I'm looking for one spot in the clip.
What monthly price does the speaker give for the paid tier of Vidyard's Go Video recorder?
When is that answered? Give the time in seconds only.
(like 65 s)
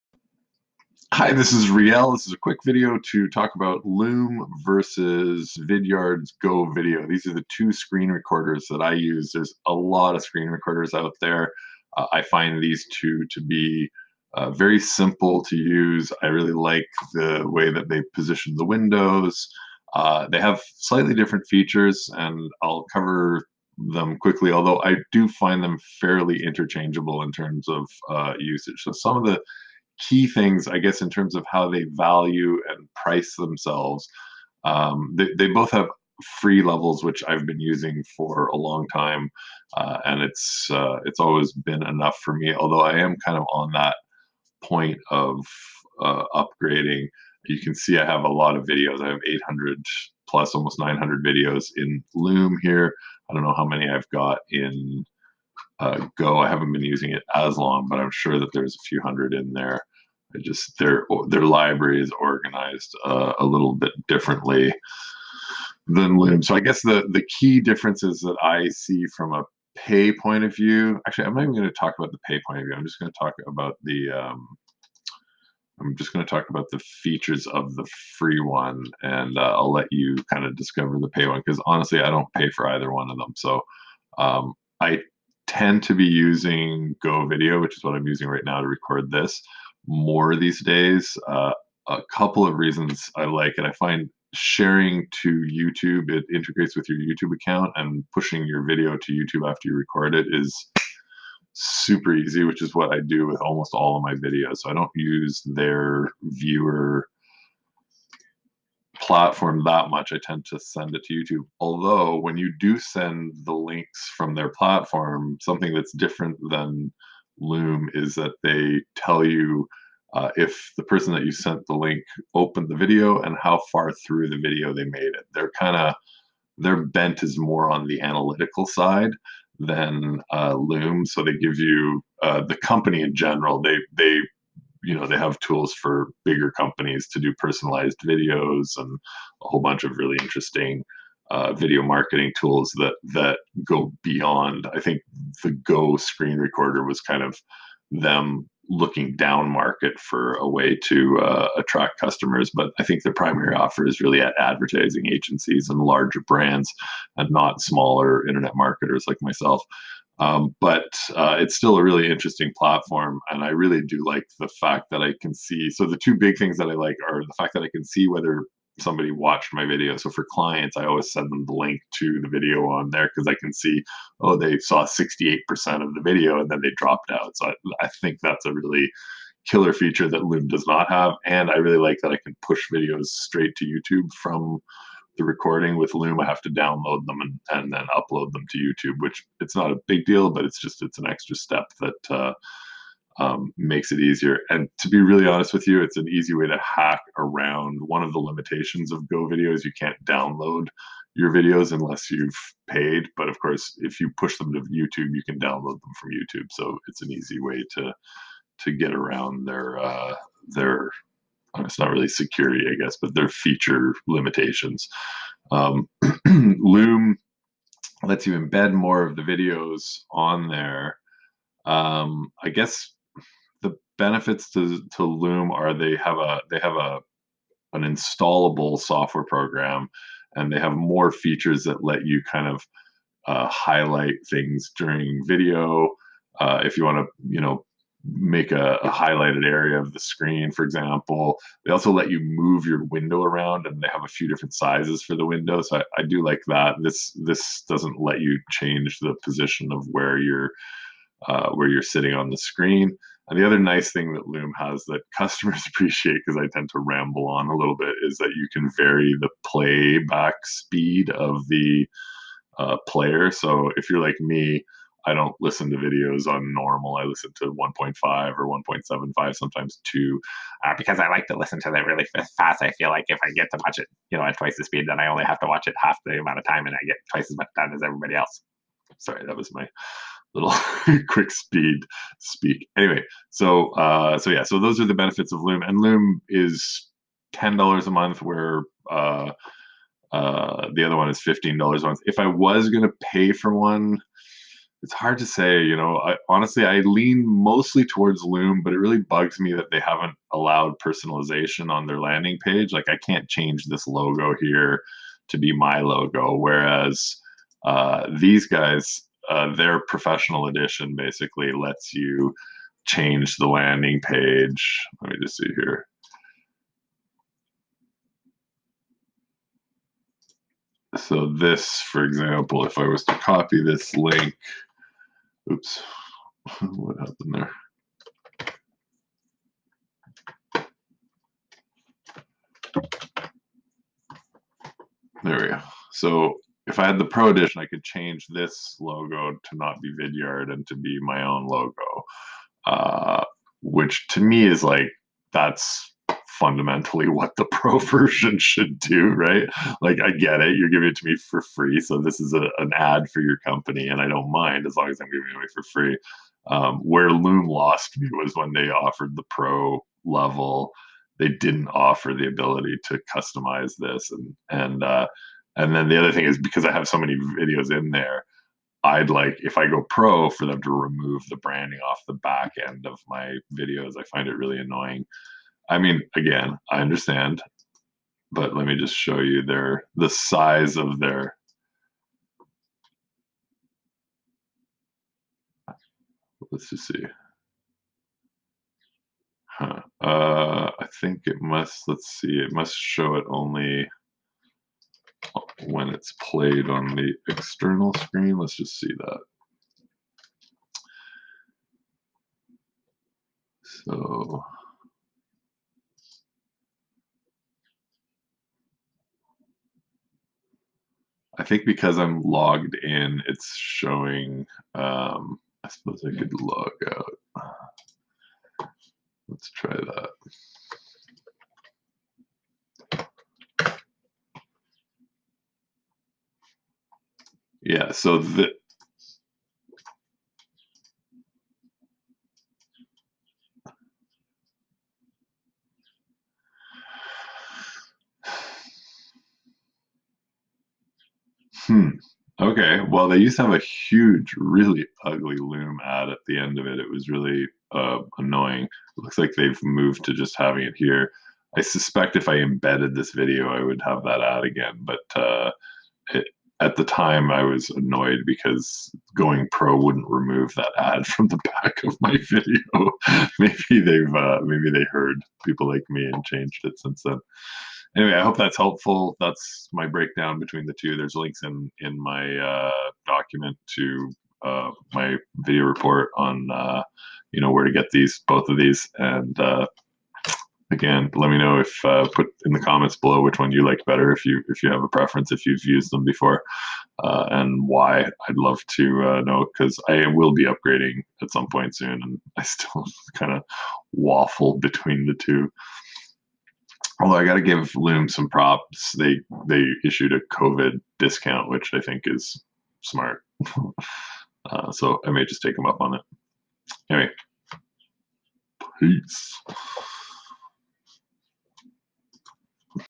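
291 s.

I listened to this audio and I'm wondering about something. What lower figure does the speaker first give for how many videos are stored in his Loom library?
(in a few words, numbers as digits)
800 plus.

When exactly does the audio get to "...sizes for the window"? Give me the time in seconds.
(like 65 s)
244 s.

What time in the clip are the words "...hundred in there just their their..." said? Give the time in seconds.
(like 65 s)
59 s.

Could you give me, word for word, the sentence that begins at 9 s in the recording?
There's a lot of screen recorders out there.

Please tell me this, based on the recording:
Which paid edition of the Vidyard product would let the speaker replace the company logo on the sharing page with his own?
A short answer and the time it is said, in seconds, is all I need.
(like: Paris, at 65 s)
Pro Edition, at 337 s.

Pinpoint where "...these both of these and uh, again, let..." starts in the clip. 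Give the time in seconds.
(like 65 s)
477 s.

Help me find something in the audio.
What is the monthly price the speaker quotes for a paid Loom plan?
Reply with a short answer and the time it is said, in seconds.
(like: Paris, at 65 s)
$10 a month, at 287 s.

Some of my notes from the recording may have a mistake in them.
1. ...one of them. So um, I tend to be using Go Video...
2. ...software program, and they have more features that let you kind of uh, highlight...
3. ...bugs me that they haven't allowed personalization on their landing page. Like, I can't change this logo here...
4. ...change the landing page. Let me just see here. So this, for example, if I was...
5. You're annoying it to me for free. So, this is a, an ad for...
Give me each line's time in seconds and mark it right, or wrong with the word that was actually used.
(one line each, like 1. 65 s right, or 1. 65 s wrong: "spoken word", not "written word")
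1. 82 s right
2. 228 s right
3. 298 s right
4. 312 s right
5. 350 s wrong: "giving", not "annoying".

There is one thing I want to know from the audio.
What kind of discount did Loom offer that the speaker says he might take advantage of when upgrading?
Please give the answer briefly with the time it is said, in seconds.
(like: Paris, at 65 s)
COVID discount, at 500 s.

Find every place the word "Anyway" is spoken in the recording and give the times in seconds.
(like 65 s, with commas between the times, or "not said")
282 s, 467 s, 506 s.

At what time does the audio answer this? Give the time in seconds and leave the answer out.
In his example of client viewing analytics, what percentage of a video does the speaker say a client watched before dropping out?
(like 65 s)
174 s.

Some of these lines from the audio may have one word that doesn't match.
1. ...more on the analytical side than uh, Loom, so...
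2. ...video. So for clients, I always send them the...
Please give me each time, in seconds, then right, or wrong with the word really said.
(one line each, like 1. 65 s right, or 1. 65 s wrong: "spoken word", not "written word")
1. 127 s right
2. 169 s right.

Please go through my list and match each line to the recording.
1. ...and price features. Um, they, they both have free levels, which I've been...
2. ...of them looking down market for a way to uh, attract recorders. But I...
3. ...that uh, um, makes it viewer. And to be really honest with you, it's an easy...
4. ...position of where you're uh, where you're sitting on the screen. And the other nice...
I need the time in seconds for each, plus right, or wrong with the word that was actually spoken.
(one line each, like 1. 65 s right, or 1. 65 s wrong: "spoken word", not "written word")
1. 32 s wrong: "themselves", not "features"
2. 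147 s wrong: "customers", not "recorders"
3. 191 s wrong: "easier", not "viewer"
4. 249 s right.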